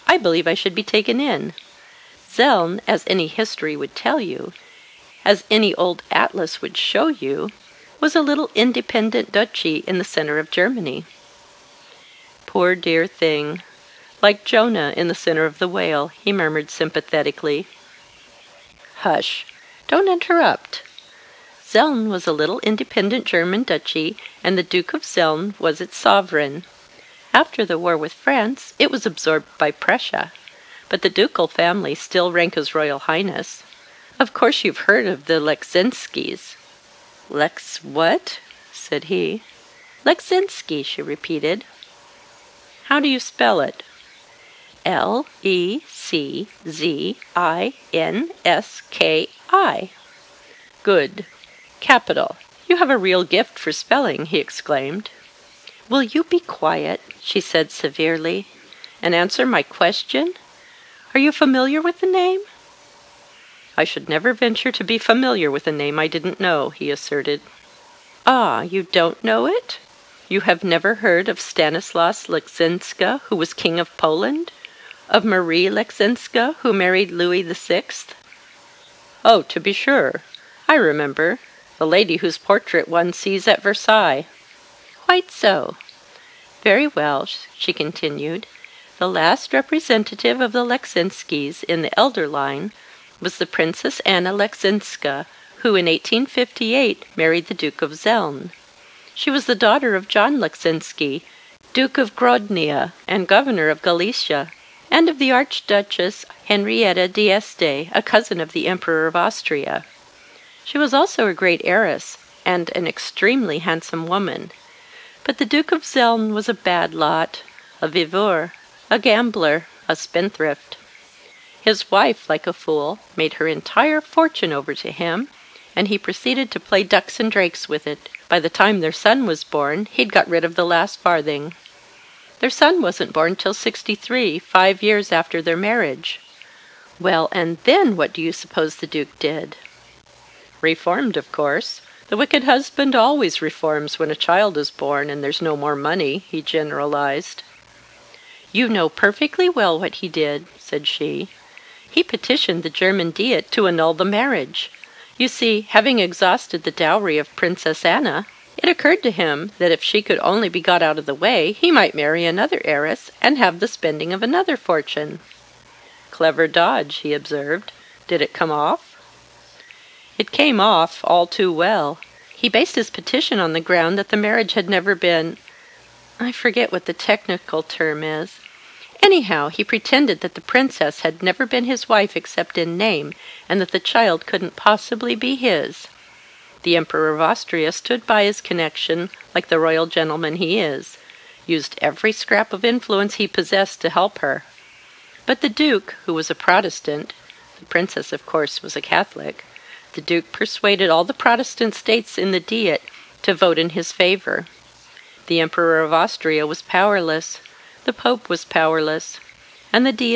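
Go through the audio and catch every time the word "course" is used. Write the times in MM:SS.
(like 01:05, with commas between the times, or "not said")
00:34, 02:21, 03:18.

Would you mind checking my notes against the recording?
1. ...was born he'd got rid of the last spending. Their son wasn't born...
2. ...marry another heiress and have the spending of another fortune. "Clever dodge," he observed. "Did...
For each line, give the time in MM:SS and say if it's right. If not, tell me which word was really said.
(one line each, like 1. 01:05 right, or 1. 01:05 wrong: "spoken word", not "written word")
1. 02:09 wrong: "farthing", not "spending"
2. 02:41 right.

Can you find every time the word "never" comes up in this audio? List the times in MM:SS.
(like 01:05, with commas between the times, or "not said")
01:04, 01:10, 02:54, 03:01.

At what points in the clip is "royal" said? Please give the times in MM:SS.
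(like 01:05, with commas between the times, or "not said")
00:32, 03:09.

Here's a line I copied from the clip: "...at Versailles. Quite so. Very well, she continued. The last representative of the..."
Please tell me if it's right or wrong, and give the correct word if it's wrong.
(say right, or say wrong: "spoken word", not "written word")
right.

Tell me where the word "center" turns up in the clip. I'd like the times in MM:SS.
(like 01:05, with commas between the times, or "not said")
00:10, 00:15.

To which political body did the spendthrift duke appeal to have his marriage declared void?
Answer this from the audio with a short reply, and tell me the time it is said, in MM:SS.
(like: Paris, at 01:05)
the German Diet, at 02:32.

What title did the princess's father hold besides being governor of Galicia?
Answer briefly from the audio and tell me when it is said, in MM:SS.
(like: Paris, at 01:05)
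Duke of Grodnia, at 01:41.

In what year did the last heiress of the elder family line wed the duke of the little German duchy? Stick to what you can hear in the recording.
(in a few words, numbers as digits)
1858.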